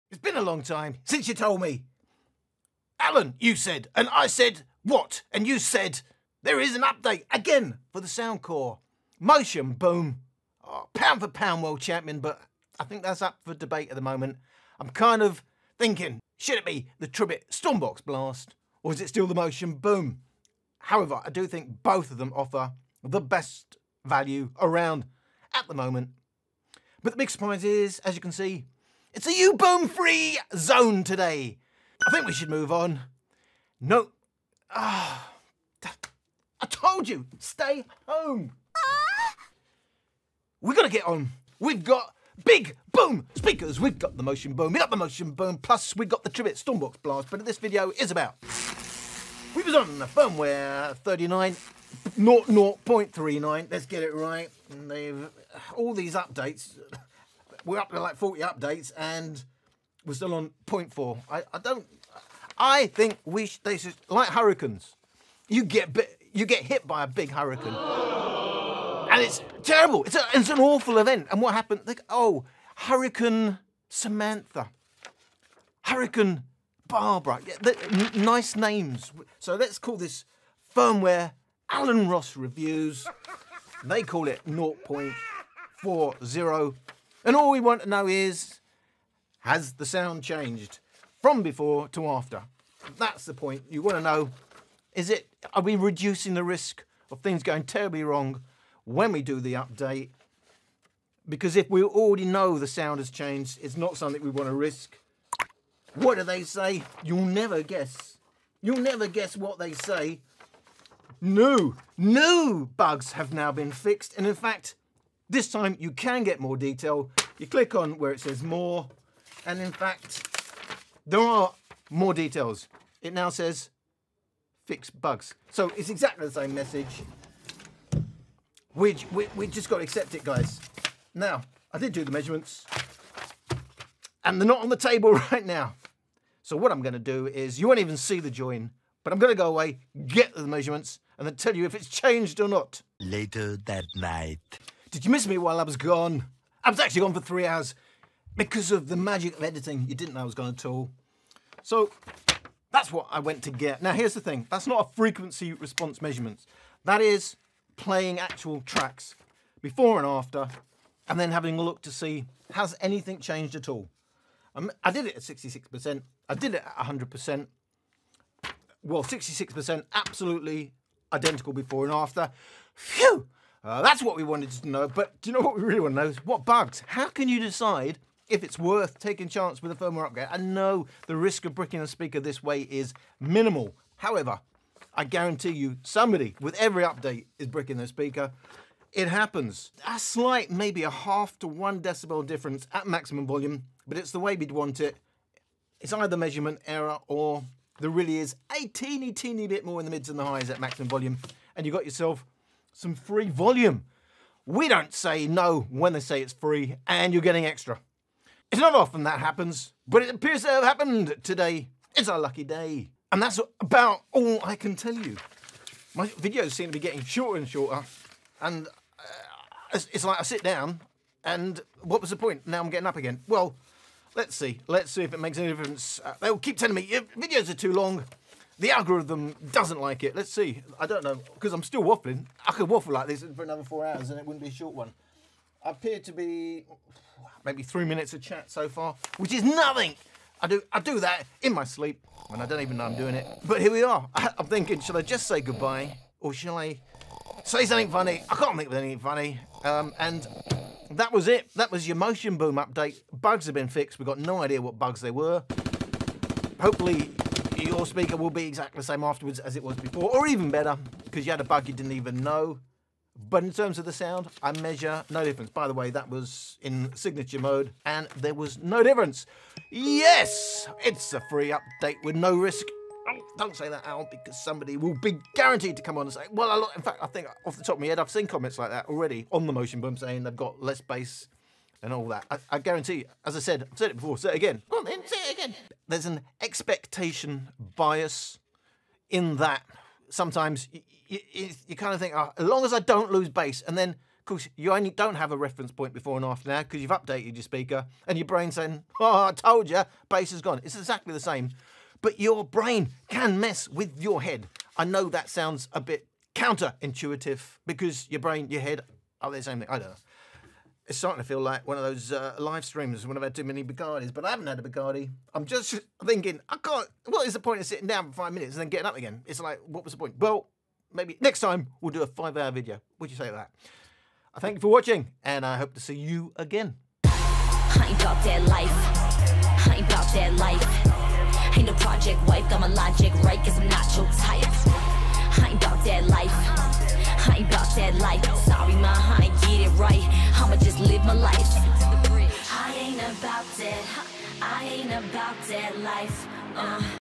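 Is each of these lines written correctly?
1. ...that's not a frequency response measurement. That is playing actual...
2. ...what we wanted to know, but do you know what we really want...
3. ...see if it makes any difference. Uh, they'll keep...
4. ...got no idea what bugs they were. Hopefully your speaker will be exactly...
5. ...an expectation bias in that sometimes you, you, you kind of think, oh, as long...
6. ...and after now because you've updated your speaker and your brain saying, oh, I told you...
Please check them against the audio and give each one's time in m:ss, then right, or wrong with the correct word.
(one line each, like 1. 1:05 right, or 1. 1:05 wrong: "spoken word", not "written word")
1. 2:34 right
2. 2:54 right
3. 3:44 right
4. 4:14 right
5. 4:46 right
6. 4:56 right.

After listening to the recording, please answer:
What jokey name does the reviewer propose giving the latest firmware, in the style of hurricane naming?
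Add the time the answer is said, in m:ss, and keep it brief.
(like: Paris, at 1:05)
Alan Ross Reviews, at 1:21.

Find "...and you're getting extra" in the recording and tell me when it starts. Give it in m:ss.
3:26.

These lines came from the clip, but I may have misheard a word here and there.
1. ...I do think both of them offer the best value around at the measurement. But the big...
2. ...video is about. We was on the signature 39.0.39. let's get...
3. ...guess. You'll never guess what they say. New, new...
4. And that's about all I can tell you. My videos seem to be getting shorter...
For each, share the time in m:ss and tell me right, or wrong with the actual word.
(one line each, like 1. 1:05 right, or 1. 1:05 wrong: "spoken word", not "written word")
1. 0:21 wrong: "moment", not "measurement"
2. 0:47 wrong: "firmware", not "signature"
3. 1:47 right
4. 3:33 right.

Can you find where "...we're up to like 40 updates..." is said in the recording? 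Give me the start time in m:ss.
0:57.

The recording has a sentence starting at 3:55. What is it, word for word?
I appear to be maybe three minutes of chat so far, which is nothing.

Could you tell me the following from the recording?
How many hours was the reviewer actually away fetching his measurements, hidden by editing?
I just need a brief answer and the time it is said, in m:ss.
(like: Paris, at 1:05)
3, at 2:27.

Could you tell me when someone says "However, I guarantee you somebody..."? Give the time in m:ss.
3:03.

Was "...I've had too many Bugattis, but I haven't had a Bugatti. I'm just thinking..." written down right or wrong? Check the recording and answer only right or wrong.
right.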